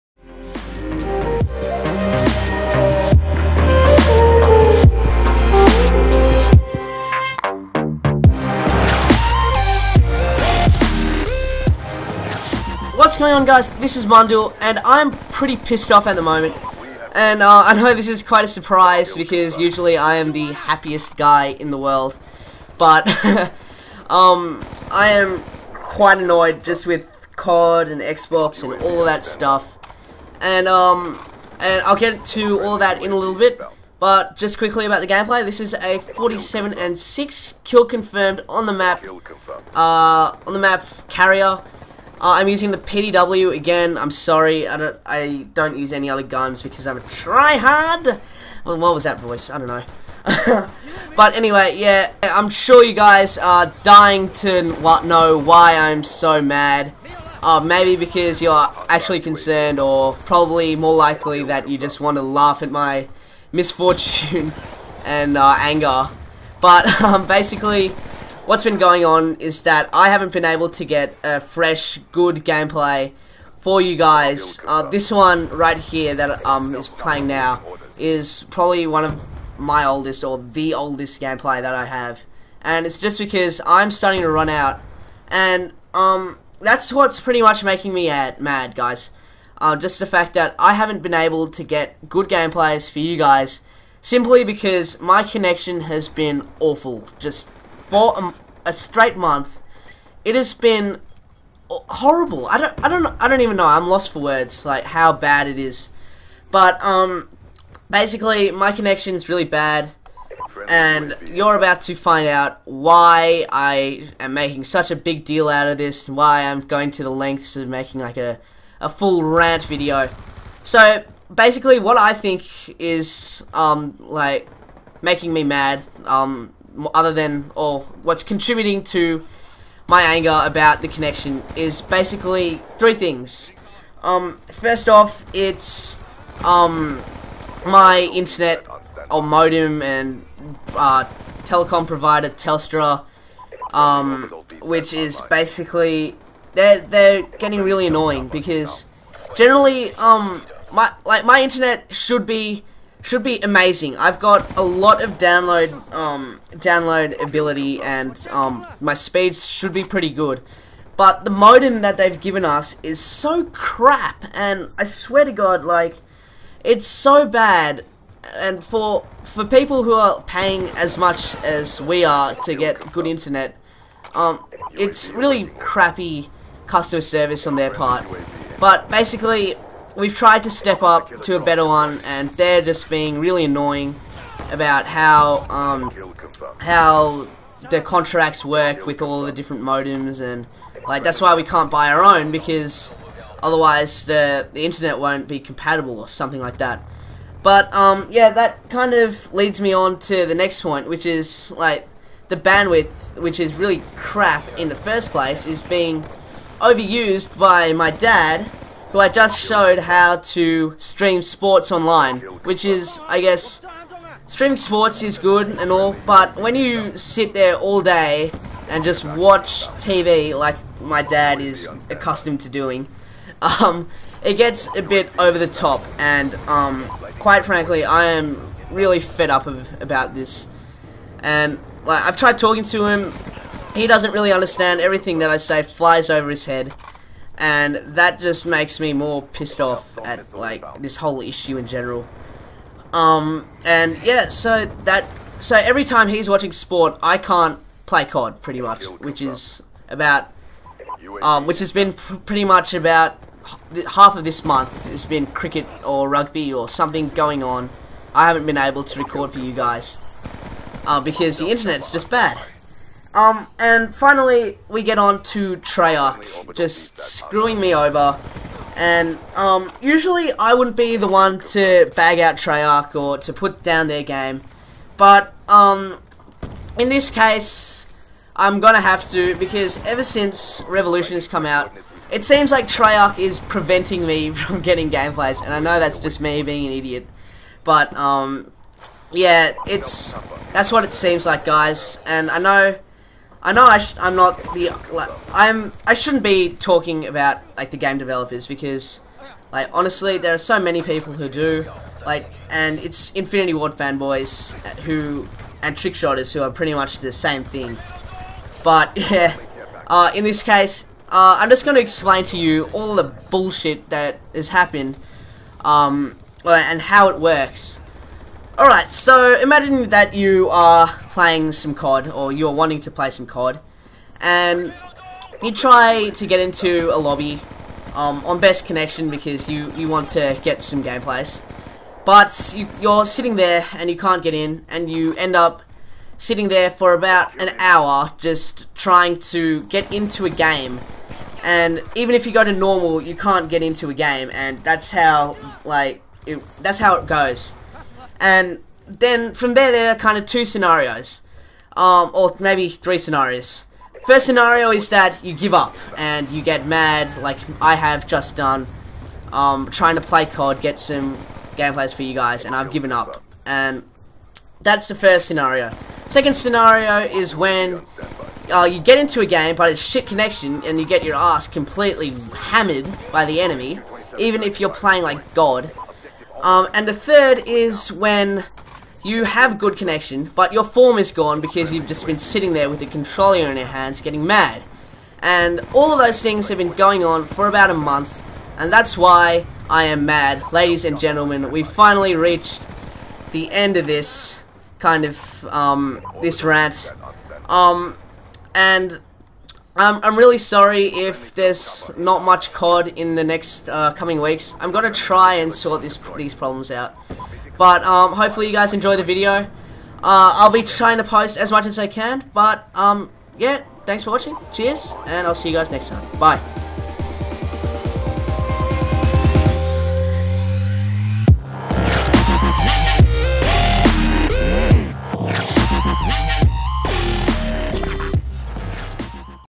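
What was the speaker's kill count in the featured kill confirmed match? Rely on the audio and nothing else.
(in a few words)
47.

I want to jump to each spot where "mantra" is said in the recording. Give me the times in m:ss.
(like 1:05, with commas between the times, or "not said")
not said.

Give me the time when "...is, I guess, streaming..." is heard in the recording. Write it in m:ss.
3:32.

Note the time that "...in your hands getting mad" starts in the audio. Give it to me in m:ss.
6:23.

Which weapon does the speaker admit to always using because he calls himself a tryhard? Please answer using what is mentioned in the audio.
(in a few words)
PDW.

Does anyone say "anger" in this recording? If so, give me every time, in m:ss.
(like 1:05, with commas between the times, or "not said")
1:05, 2:10.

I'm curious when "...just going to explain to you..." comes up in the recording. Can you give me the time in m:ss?
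5:11.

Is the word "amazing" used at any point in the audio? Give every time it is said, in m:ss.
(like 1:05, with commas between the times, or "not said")
2:33.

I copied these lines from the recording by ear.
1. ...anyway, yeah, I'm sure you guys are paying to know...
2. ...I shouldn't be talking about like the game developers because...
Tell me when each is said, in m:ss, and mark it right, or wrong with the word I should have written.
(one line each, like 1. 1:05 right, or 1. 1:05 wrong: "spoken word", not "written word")
1. 0:51 wrong: "dying", not "paying"
2. 4:55 right.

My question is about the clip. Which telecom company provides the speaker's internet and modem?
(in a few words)
Telstra.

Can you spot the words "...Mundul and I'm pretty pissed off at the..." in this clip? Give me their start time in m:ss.
0:14.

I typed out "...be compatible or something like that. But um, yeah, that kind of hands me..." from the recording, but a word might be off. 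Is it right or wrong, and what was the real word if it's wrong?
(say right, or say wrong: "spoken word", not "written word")
wrong: "leads", not "hands".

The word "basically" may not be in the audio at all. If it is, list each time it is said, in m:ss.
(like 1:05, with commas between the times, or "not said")
1:07, 1:47, 2:01, 2:11, 2:25, 2:58.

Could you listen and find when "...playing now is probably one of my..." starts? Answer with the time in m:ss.
1:16.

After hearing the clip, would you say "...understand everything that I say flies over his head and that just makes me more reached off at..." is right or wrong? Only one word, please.
wrong.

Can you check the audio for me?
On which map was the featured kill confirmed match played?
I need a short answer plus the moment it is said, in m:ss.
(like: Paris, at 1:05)
Carrier, at 0:41.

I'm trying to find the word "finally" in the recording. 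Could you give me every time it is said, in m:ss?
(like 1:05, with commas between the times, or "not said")
4:23, 6:31.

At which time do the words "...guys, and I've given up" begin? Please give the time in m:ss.
6:02.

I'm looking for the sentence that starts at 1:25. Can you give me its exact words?
And um, that's what's pretty much making me mad, guys.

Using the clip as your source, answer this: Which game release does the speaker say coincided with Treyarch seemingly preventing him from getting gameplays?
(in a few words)
Revolution.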